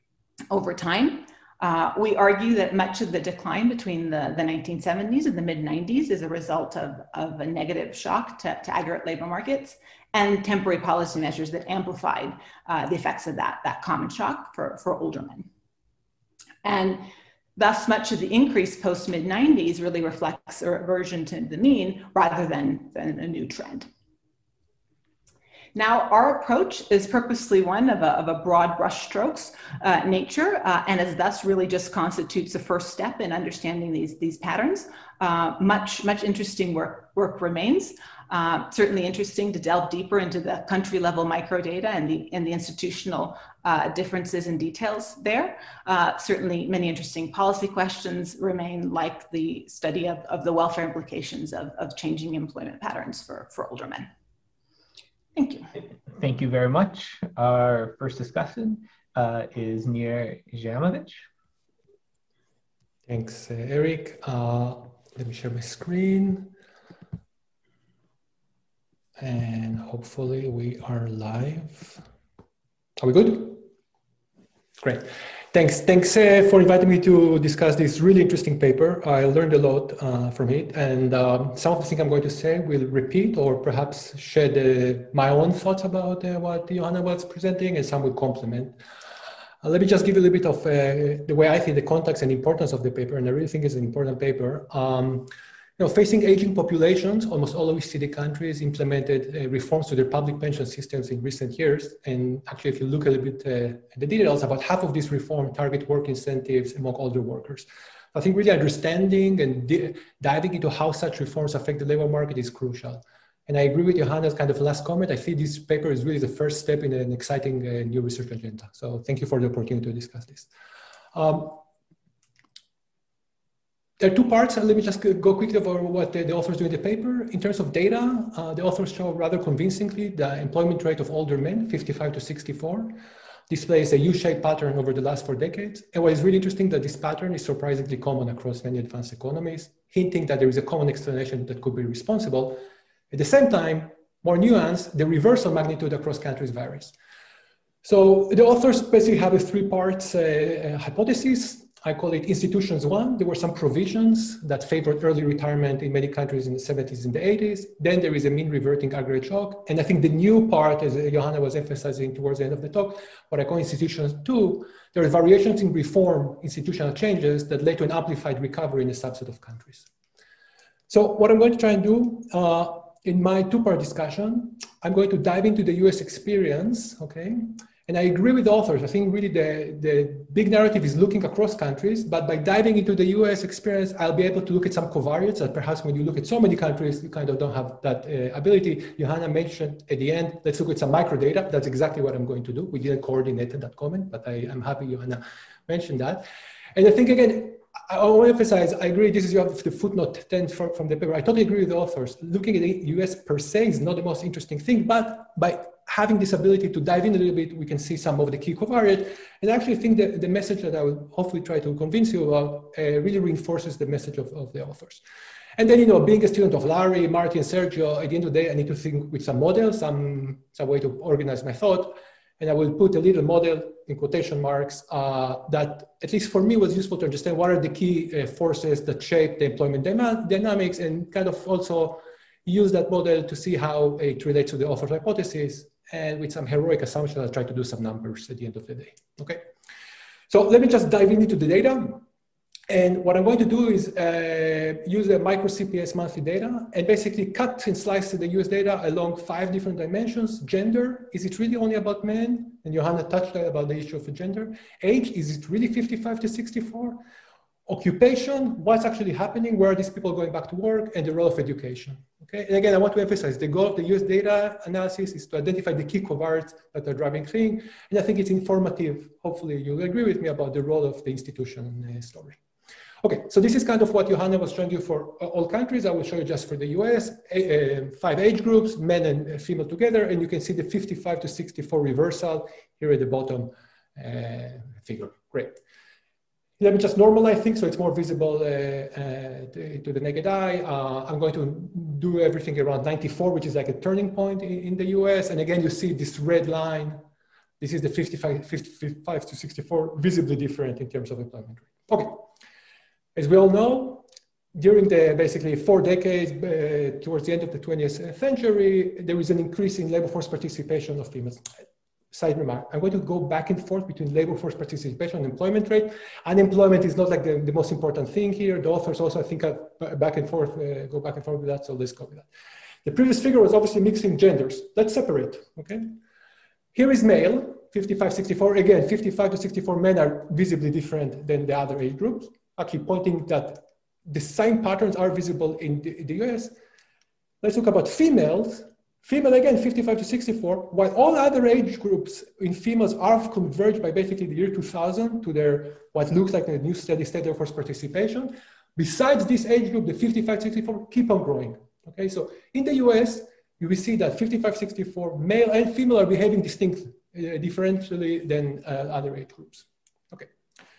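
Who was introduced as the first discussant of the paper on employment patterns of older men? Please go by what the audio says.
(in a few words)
Nir Jaimovich.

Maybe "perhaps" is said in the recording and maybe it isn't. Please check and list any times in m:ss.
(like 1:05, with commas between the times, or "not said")
1:23, 3:05.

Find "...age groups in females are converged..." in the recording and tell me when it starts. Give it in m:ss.
5:41.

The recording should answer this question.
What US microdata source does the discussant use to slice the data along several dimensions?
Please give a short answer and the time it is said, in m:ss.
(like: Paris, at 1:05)
CPS monthly data, at 4:05.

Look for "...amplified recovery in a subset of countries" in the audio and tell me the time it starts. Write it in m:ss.
2:47.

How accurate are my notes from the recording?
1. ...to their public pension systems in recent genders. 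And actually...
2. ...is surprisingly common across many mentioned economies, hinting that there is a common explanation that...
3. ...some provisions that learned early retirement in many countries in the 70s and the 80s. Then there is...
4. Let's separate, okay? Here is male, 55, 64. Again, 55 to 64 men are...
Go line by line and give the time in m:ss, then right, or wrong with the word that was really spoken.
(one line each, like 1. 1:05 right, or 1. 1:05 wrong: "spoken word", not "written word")
1. 1:39 wrong: "years", not "genders"
2. 2:17 wrong: "advanced", not "mentioned"
3. 2:33 wrong: "favored", not "learned"
4. 5:24 right.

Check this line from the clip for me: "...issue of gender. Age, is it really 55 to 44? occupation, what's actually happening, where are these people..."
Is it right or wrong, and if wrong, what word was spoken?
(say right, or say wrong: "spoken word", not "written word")
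wrong: "64", not "44".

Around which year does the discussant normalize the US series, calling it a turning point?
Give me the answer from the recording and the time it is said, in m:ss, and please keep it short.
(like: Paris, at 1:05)
1994, at 4:52.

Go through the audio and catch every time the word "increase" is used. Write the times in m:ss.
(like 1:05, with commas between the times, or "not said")
0:18, 5:09.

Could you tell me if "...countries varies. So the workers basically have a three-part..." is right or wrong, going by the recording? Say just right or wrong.
wrong.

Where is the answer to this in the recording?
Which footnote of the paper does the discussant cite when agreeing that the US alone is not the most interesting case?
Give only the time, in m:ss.
3:19.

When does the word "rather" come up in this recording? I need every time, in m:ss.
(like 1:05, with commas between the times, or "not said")
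0:22, 2:09.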